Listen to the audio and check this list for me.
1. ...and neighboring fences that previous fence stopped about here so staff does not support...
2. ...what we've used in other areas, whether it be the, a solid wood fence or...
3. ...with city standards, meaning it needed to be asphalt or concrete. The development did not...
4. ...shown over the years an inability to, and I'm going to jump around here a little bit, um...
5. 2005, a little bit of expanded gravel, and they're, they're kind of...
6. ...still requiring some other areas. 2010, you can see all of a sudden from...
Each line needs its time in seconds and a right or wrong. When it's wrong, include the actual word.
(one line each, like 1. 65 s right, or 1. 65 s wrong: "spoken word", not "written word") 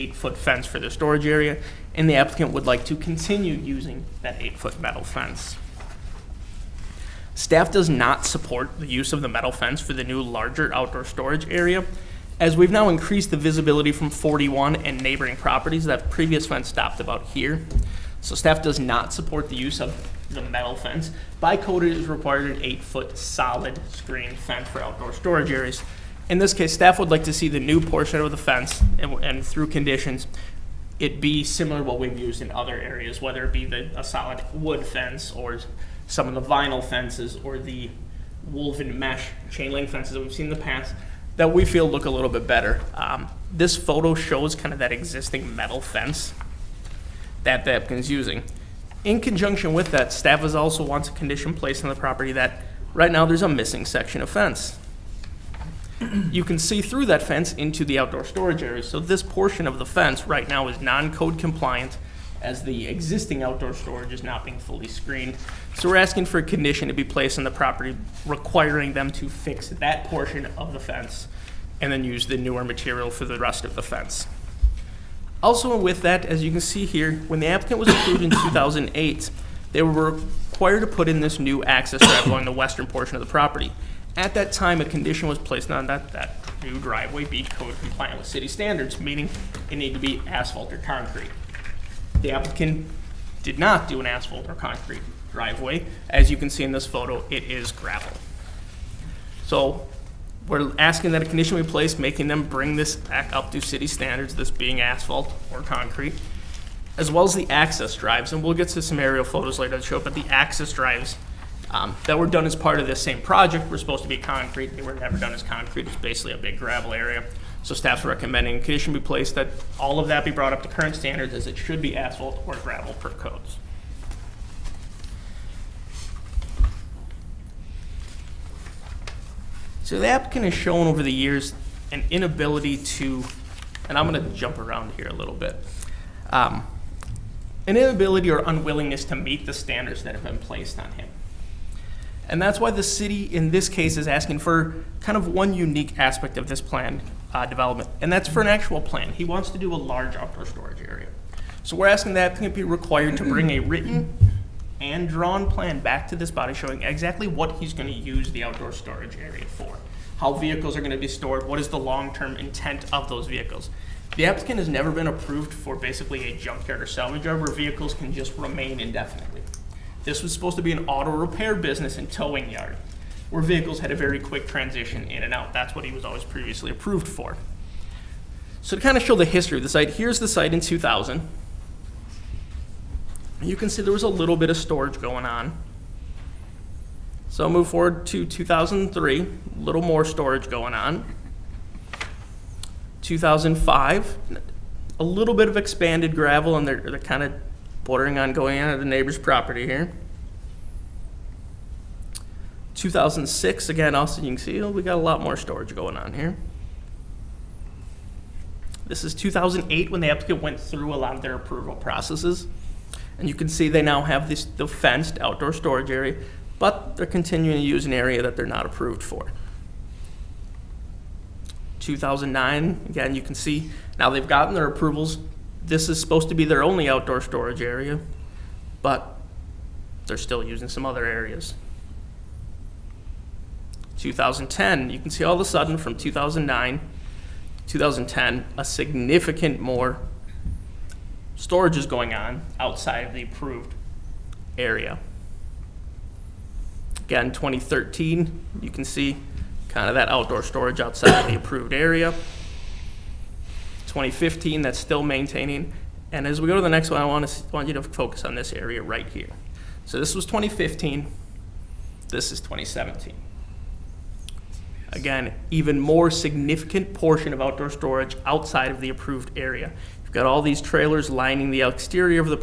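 1. 14 s wrong: "properties", not "fences"
2. 31 s right
3. 88 s wrong: "applicant", not "development"
4. 130 s right
5. 193 s right
6. 230 s wrong: "using", not "requiring".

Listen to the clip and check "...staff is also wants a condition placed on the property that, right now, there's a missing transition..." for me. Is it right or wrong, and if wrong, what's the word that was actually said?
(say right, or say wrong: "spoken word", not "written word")
wrong: "section", not "transition".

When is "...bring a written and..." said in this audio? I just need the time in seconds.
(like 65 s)
153 s.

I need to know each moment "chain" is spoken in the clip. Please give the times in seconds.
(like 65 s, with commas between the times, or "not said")
39 s.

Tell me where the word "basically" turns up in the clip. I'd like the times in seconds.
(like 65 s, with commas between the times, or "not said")
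115 s, 165 s.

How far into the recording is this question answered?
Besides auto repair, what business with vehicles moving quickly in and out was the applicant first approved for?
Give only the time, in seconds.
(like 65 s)
172 s.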